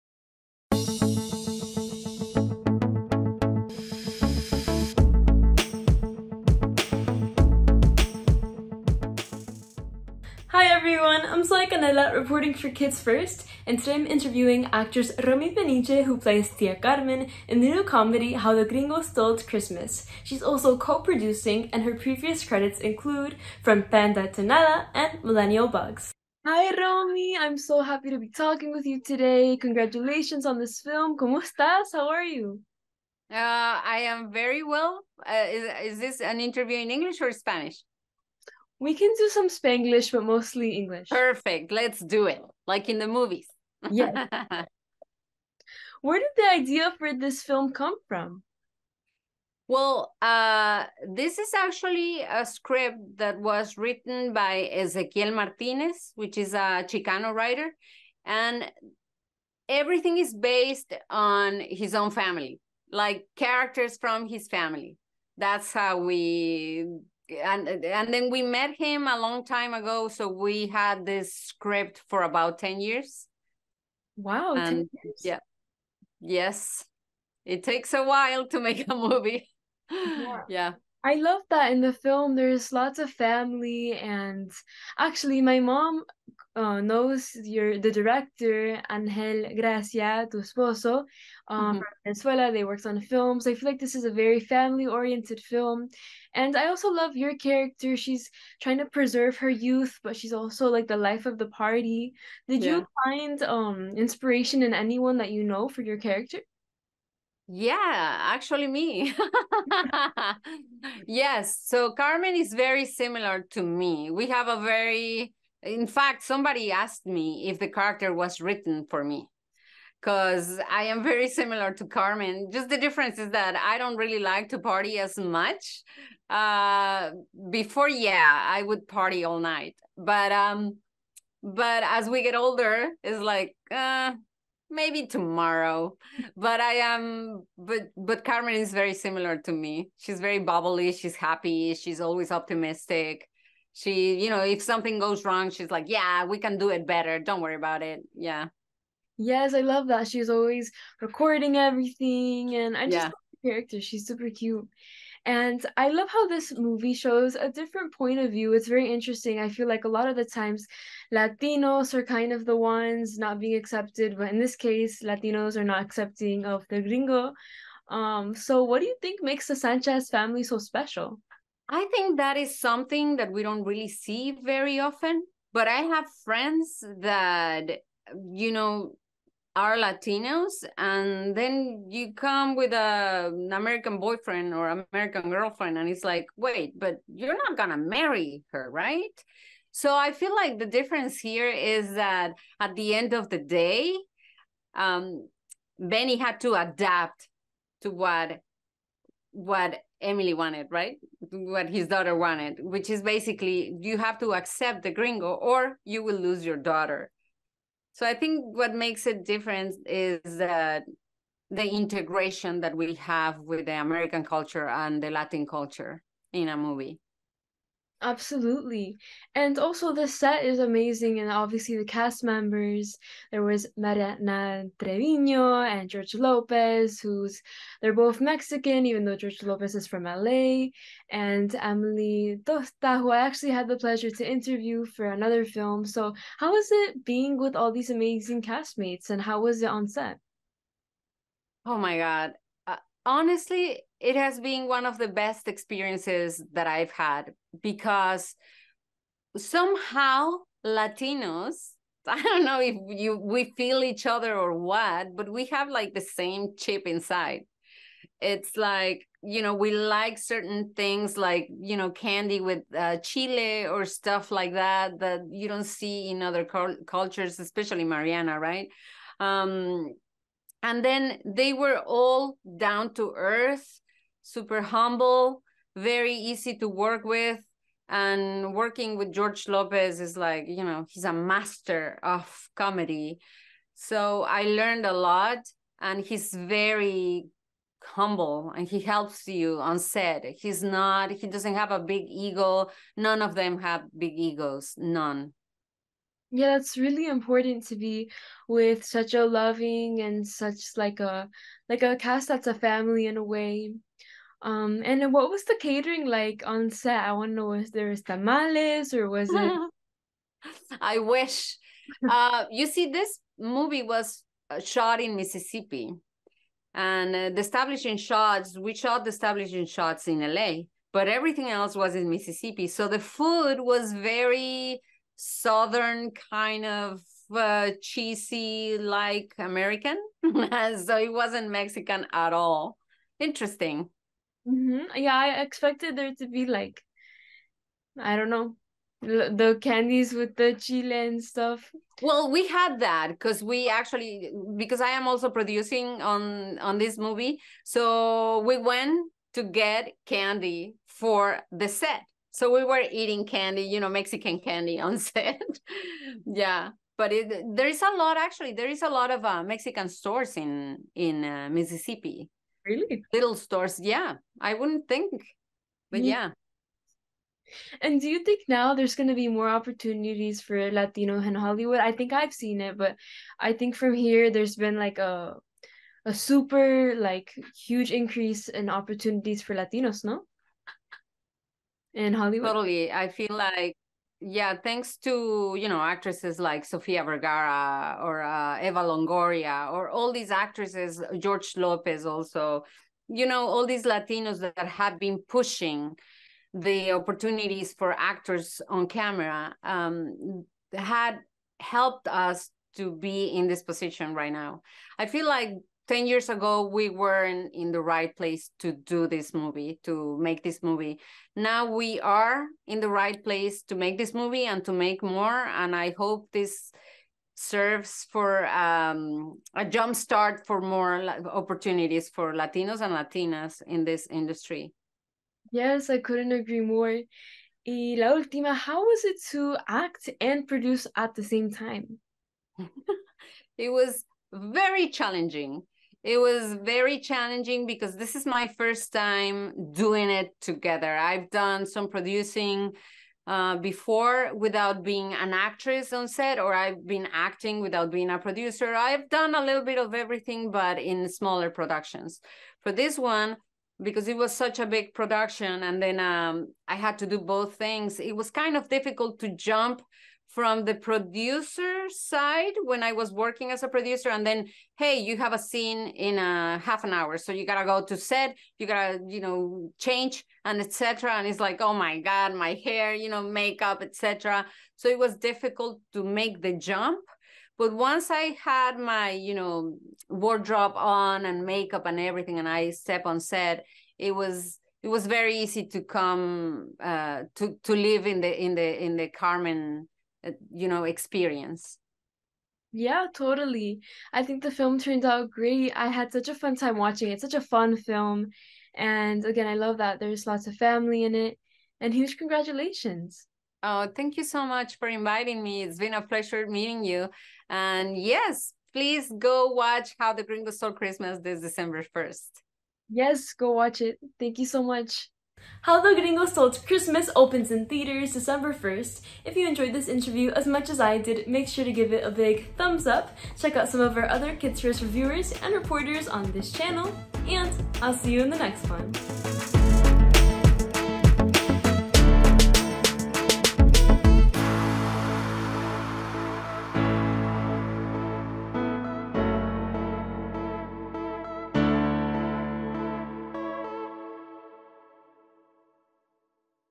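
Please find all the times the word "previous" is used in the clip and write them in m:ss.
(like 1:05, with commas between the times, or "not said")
0:21.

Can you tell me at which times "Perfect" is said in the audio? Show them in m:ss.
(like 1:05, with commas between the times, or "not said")
0:41.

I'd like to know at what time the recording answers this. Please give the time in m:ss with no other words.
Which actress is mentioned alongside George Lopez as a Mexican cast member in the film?
3:43.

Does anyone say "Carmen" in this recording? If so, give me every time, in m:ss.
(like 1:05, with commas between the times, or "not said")
0:16, 1:51, 2:01, 2:18, 8:09.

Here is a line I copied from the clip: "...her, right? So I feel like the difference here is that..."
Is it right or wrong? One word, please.
right.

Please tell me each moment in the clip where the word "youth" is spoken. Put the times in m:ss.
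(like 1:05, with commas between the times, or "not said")
1:39.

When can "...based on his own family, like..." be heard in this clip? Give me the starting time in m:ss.
1:00.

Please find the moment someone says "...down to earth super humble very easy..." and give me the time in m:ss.
4:32.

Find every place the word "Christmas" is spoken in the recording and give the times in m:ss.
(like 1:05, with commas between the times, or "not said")
0:19, 8:30, 8:36.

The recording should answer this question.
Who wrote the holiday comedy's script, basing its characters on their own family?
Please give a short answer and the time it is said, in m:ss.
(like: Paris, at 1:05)
Ezequiel Martinez, at 0:54.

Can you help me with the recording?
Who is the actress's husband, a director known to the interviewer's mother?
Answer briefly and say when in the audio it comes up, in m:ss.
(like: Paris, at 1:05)
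Angel Gracia, at 1:28.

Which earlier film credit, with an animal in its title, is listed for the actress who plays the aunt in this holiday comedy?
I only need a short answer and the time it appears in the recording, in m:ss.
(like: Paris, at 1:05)
From Panda to Nada, at 0:23.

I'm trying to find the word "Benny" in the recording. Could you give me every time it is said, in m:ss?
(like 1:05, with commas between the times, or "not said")
3:15.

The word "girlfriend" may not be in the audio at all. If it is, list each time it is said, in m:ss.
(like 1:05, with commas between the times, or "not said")
3:05.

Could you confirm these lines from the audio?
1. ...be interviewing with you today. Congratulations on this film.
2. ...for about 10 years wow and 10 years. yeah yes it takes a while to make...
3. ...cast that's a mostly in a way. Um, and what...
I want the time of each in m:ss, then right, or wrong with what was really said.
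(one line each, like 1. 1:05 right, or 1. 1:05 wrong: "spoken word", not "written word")
1. 0:28 wrong: "talking", not "interviewing"
2. 1:12 right
3. 5:01 wrong: "family", not "mostly".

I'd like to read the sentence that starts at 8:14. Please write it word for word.
I think the film turned out great.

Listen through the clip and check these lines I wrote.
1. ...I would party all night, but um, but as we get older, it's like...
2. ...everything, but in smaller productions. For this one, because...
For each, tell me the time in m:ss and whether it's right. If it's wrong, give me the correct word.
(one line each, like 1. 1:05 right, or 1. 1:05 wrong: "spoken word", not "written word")
1. 2:08 right
2. 7:29 right.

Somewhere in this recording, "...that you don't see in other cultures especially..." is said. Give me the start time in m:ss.
4:24.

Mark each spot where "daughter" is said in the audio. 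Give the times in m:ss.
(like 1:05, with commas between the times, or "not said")
3:21, 3:26.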